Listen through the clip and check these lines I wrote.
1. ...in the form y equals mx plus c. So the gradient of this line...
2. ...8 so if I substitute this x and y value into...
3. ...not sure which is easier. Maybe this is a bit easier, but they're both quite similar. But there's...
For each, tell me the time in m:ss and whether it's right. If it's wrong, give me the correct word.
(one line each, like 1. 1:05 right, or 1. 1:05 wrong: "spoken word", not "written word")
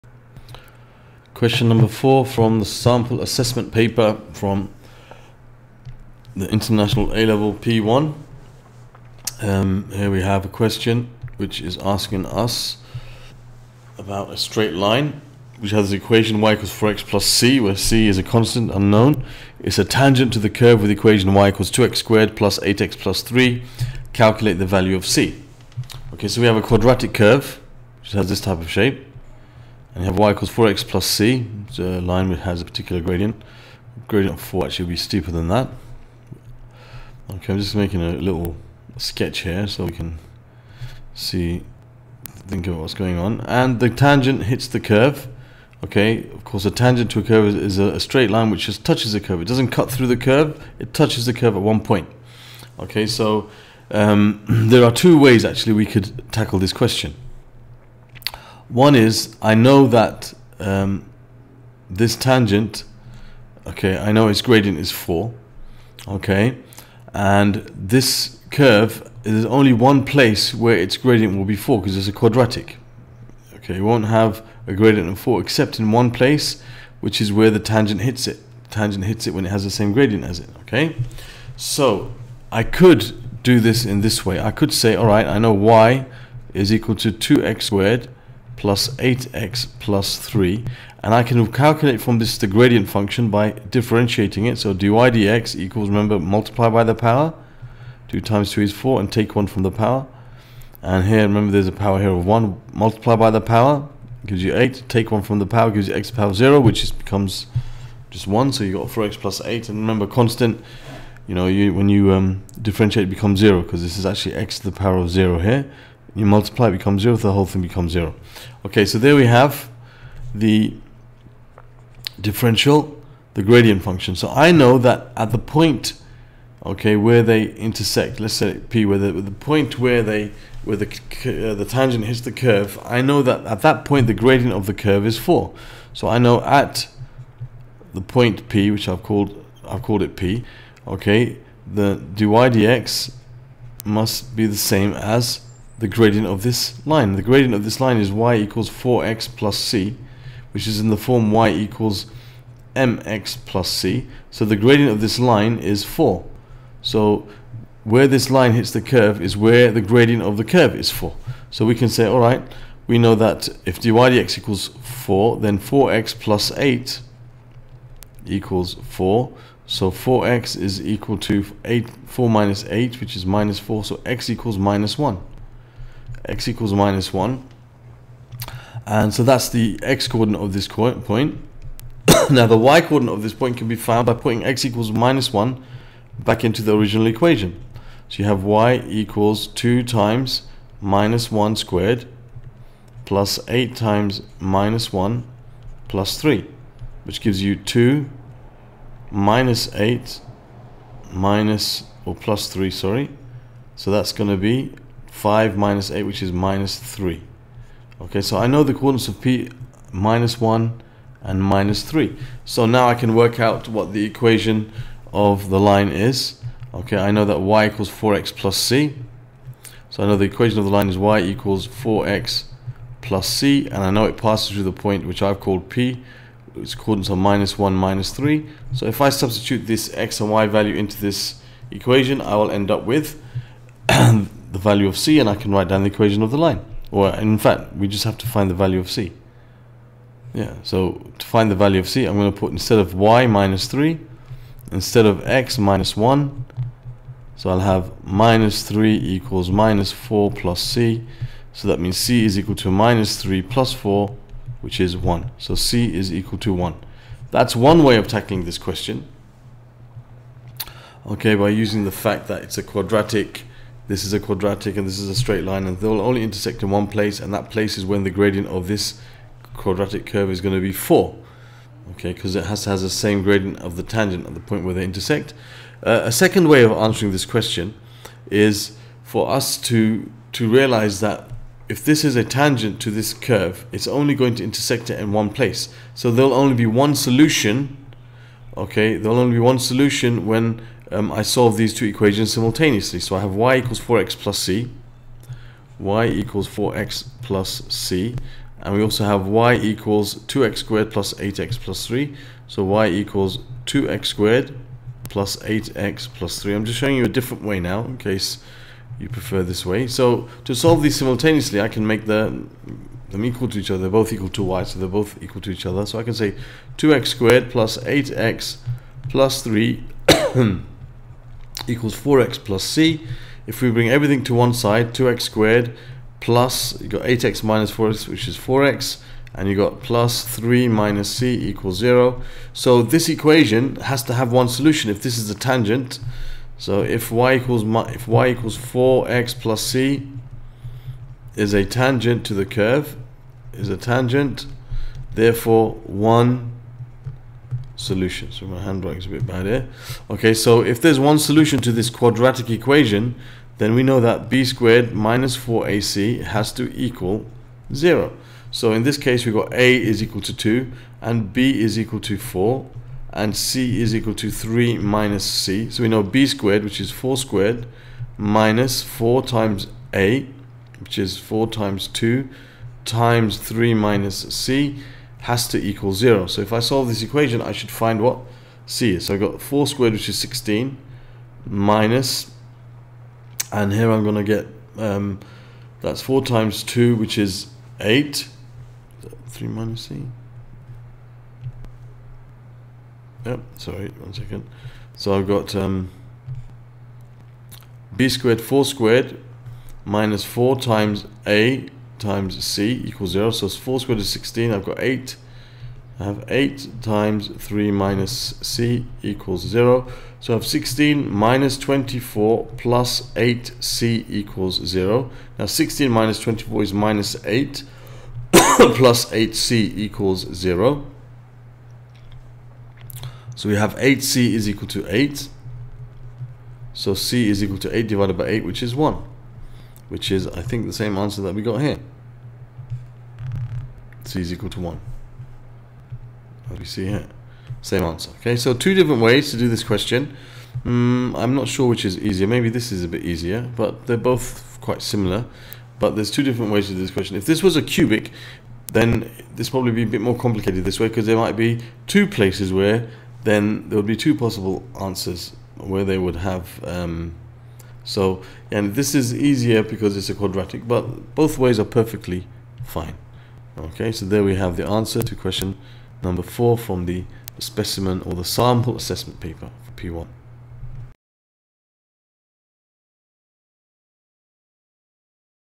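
1. 2:30 right
2. 3:48 wrong: "3", not "8"
3. 7:21 right.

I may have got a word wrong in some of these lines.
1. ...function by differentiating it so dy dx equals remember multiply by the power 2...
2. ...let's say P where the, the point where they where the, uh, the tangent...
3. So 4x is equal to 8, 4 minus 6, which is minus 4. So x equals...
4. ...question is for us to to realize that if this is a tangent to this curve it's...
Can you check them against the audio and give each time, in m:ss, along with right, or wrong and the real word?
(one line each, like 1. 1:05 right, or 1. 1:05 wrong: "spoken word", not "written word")
1. 1:32 right
2. 2:08 right
3. 2:49 wrong: "8", not "6"
4. 4:37 right.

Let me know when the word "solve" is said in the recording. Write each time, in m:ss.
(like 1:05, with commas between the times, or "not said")
4:51, 5:10, 6:16.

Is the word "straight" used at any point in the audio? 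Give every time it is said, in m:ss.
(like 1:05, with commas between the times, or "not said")
0:14, 0:47, 4:25.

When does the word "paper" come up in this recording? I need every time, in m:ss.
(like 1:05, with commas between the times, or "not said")
0:03, 7:49.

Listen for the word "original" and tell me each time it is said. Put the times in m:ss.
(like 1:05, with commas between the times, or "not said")
3:06.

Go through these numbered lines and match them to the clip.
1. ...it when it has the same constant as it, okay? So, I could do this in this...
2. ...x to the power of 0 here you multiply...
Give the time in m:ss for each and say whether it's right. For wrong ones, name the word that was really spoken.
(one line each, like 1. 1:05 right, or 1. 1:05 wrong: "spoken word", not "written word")
1. 1:19 wrong: "gradient", not "constant"
2. 1:54 right.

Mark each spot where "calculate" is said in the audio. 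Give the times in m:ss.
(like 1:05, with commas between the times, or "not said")
0:24, 1:31.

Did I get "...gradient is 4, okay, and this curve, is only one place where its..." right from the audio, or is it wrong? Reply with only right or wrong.
right.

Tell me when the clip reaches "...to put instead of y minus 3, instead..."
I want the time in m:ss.
4:02.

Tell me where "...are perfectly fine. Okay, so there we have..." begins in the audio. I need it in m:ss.
7:41.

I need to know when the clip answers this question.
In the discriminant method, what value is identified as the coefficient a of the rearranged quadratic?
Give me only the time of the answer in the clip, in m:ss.
5:59.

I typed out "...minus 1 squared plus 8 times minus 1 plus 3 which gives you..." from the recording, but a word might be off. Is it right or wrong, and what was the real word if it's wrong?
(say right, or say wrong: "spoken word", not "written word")
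right.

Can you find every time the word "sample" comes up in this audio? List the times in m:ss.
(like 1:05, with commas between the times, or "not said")
0:02, 7:48.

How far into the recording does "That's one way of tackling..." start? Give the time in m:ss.
4:17.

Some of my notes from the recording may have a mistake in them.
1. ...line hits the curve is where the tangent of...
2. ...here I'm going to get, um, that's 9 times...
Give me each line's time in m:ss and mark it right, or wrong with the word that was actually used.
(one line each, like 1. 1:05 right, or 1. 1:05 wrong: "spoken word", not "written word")
1. 2:38 wrong: "gradient", not "tangent"
2. 6:23 wrong: "4", not "9".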